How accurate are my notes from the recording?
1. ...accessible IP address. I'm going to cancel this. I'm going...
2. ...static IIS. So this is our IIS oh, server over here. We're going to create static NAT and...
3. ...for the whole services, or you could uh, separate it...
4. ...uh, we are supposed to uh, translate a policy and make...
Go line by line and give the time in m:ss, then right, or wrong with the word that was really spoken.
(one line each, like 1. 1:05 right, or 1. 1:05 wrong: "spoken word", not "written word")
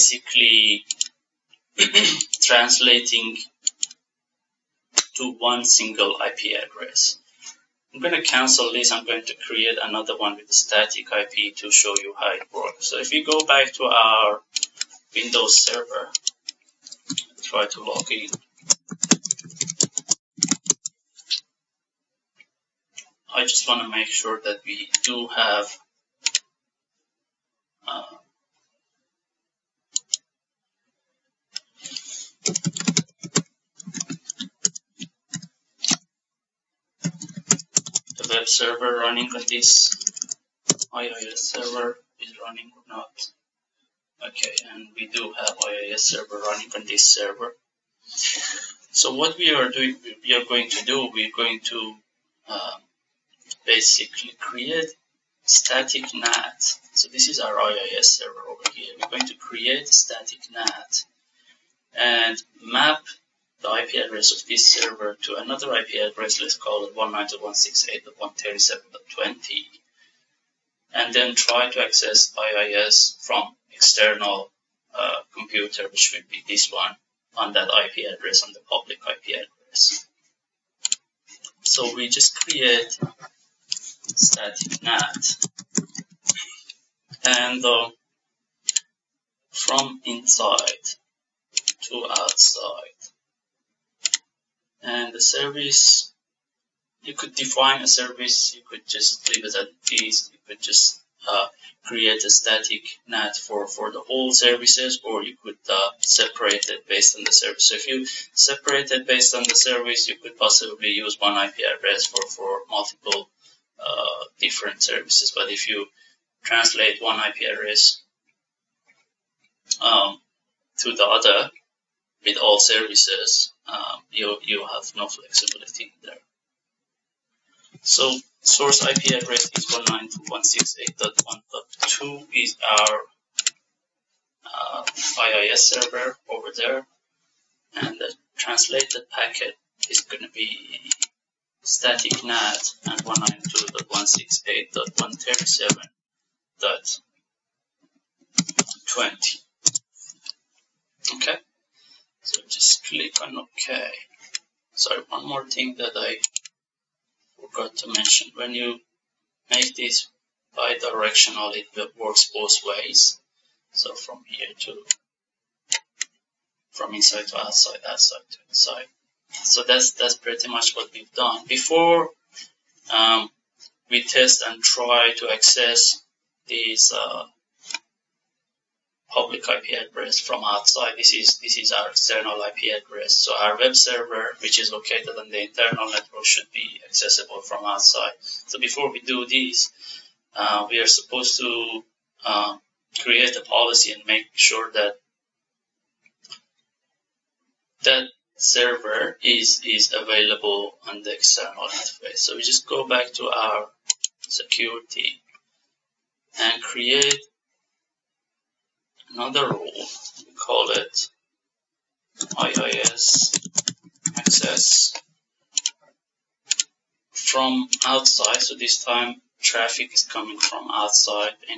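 1. 0:05 wrong: "single", not "accessible"
2. 0:55 wrong: "NAT", not "IIS"
3. 1:43 right
4. 3:10 wrong: "create", not "translate".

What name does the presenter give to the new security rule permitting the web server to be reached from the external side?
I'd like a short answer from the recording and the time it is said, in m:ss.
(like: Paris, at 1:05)
IIS access from outside, at 3:32.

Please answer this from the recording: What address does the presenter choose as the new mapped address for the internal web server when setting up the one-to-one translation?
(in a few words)
192.168.137.20.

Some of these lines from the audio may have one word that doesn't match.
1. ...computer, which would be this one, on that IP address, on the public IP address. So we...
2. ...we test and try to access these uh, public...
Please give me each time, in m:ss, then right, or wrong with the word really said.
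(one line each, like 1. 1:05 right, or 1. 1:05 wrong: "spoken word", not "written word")
1. 1:15 right
2. 2:53 right.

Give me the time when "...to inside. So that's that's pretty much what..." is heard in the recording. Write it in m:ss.
2:48.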